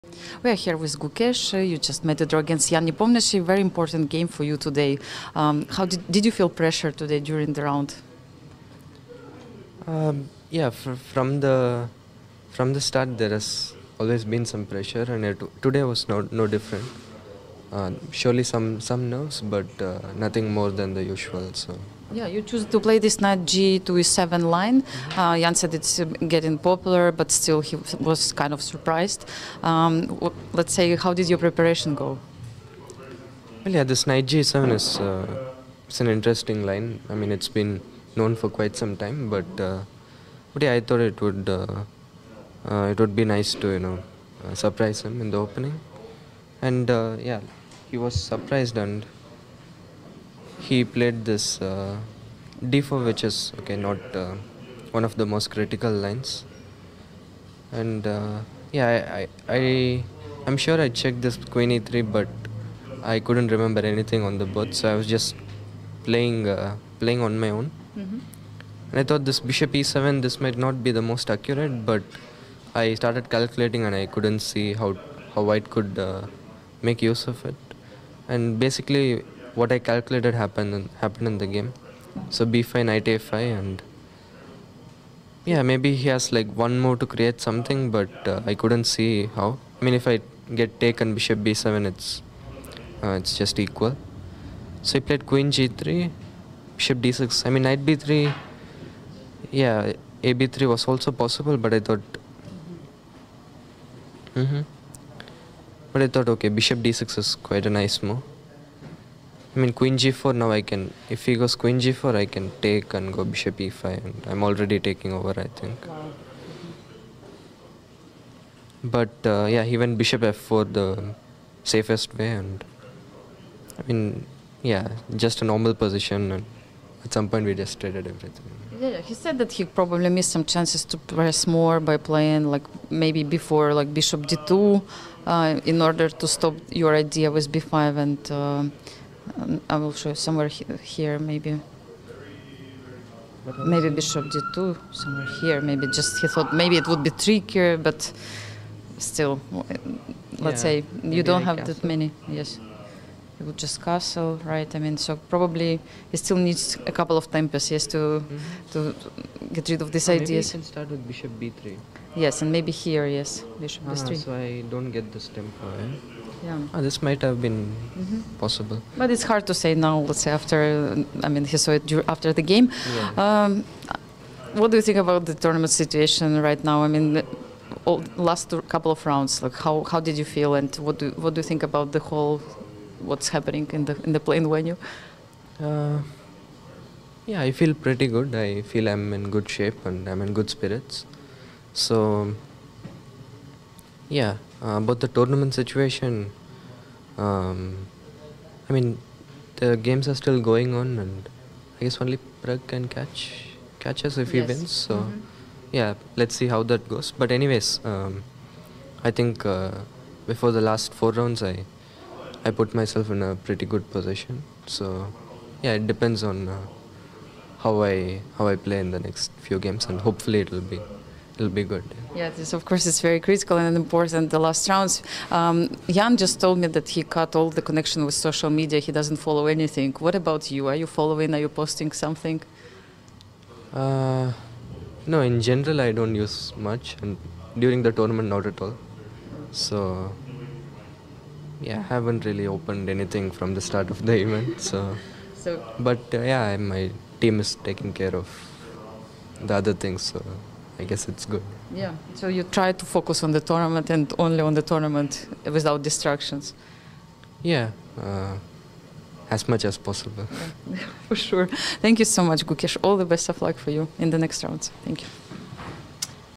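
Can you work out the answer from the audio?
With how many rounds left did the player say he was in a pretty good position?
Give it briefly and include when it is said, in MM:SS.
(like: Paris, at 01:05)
4, at 03:30.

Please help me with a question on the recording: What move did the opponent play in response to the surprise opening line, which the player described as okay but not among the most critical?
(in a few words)
d4.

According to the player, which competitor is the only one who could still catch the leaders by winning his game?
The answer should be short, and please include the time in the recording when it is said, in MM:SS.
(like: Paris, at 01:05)
Pragg, at 03:22.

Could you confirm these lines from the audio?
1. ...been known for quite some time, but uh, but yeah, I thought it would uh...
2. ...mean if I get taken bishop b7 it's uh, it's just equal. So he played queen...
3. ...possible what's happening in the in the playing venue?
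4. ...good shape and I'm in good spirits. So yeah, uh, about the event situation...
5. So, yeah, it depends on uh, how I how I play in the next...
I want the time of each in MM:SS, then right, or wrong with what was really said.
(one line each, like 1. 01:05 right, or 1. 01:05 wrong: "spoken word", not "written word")
1. 00:37 right
2. 01:29 right
3. 03:02 wrong: "whole", not "possible"
4. 03:09 wrong: "tournament", not "event"
5. 03:34 right.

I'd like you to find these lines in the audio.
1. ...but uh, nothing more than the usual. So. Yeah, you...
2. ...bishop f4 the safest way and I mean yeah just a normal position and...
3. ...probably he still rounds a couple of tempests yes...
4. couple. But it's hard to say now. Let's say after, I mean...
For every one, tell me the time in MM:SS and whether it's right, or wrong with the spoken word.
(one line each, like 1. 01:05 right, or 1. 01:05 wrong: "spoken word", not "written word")
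1. 00:19 right
2. 01:59 right
3. 02:35 wrong: "needs", not "rounds"
4. 02:48 wrong: "possible", not "couple".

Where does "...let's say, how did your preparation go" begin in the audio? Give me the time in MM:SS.
00:30.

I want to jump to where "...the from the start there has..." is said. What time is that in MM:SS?
00:11.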